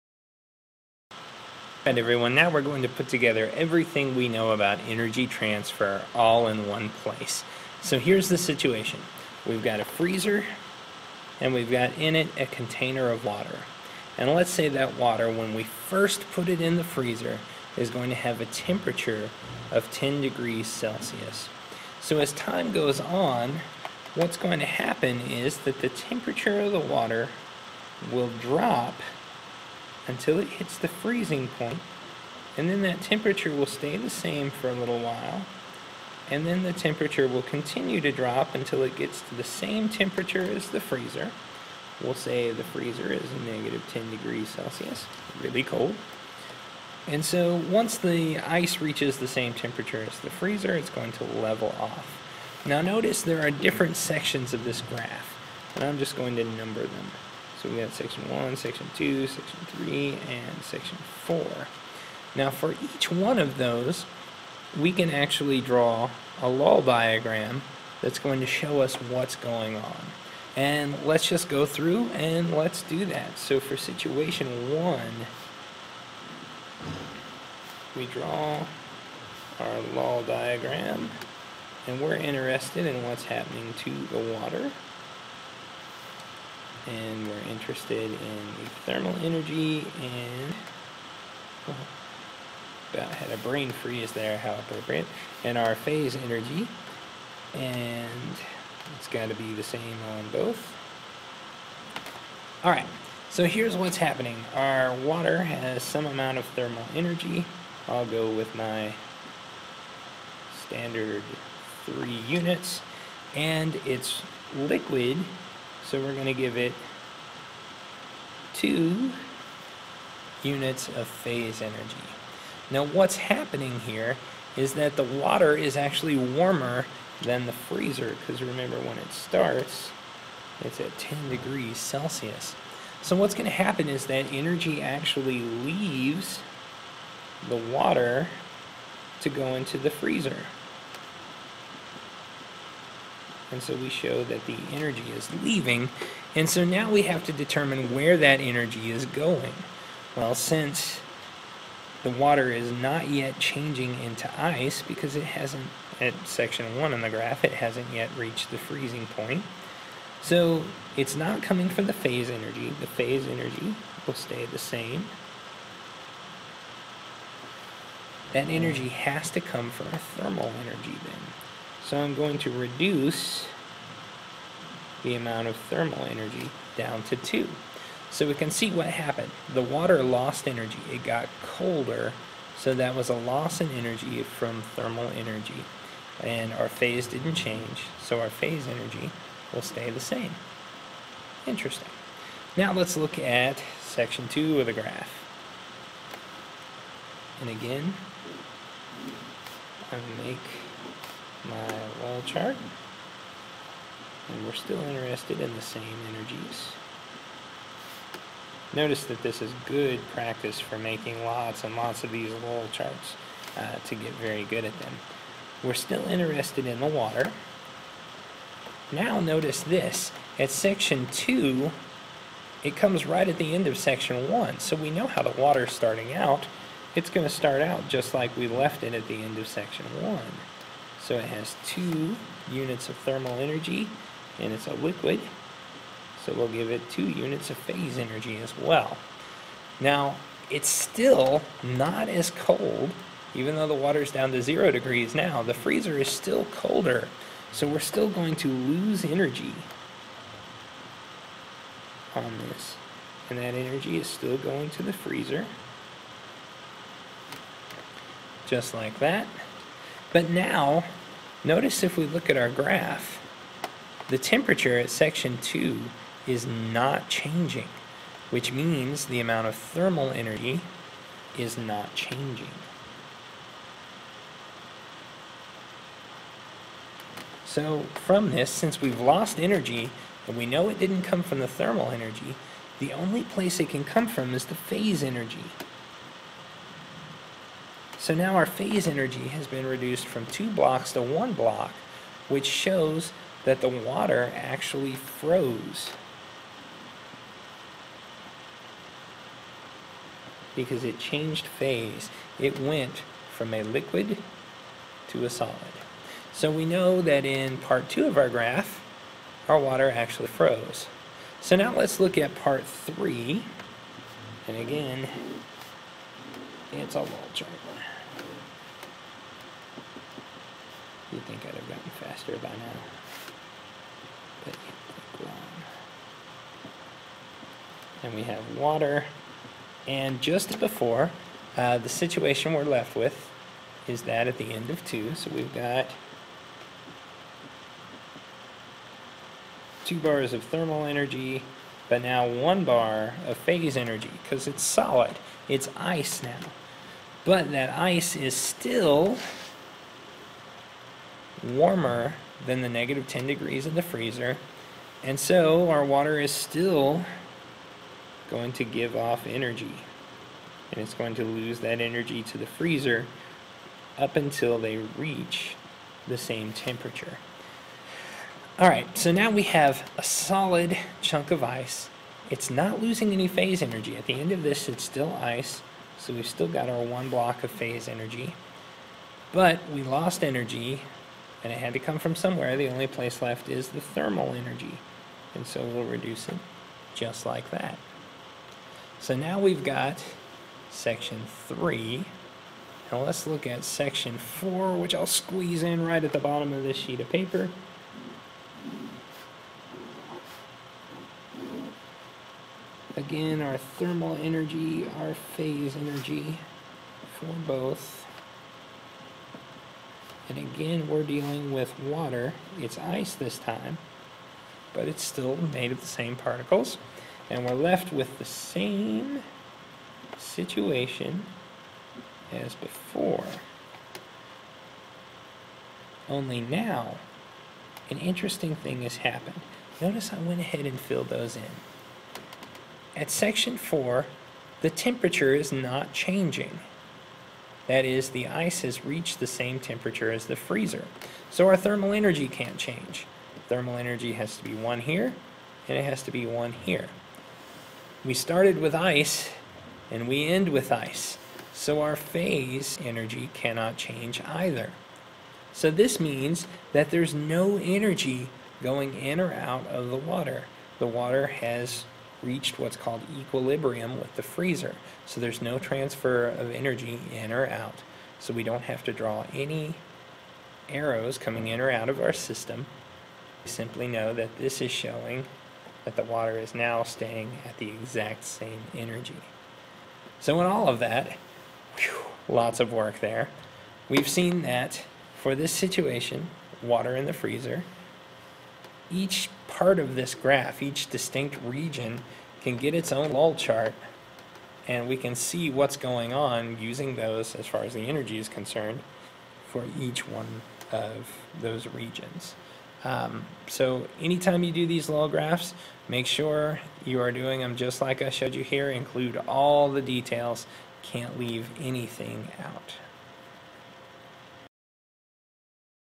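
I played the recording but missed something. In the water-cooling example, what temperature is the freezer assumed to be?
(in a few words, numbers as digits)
-10 degrees Celsius.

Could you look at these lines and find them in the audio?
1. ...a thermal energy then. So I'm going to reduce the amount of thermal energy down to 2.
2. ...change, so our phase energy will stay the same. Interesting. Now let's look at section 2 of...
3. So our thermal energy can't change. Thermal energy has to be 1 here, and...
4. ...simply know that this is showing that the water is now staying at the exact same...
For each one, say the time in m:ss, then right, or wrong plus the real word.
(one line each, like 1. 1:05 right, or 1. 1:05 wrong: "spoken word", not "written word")
1. 2:49 right
2. 3:07 right
3. 7:21 right
4. 7:53 right.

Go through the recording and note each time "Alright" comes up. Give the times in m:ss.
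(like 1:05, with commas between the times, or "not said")
0:01, 6:08.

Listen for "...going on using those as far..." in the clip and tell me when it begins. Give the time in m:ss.
8:15.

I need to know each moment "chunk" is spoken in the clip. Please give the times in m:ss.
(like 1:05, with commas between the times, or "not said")
6:11.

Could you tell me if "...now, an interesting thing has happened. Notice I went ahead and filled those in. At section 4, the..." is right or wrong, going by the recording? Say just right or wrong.
right.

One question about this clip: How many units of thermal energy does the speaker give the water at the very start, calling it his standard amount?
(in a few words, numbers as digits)
3.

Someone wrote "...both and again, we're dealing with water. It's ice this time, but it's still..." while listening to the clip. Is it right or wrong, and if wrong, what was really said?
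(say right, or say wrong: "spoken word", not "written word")
right.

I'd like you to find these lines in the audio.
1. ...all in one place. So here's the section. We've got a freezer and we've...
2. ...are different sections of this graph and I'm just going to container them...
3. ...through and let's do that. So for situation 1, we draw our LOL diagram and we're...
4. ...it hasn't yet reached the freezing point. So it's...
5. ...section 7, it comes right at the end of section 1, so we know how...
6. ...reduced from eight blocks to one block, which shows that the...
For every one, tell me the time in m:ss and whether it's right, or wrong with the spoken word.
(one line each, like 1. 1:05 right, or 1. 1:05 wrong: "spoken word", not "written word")
1. 0:06 wrong: "situation", not "section"
2. 0:53 wrong: "number", not "container"
3. 1:11 right
4. 2:37 right
5. 3:40 wrong: "2", not "7"
6. 4:49 wrong: "two", not "eight".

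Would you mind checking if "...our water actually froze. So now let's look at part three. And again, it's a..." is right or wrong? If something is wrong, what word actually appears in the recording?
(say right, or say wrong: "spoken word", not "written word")
right.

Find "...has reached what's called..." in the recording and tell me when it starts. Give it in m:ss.
7:41.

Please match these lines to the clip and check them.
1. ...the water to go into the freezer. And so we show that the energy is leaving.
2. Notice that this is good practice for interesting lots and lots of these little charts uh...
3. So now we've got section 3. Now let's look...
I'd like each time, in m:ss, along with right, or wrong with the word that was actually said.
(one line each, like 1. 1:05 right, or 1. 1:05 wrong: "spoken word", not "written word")
1. 2:17 right
2. 3:28 wrong: "making", not "interesting"
3. 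6:28 right.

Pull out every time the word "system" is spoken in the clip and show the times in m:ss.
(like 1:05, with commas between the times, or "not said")
7:52.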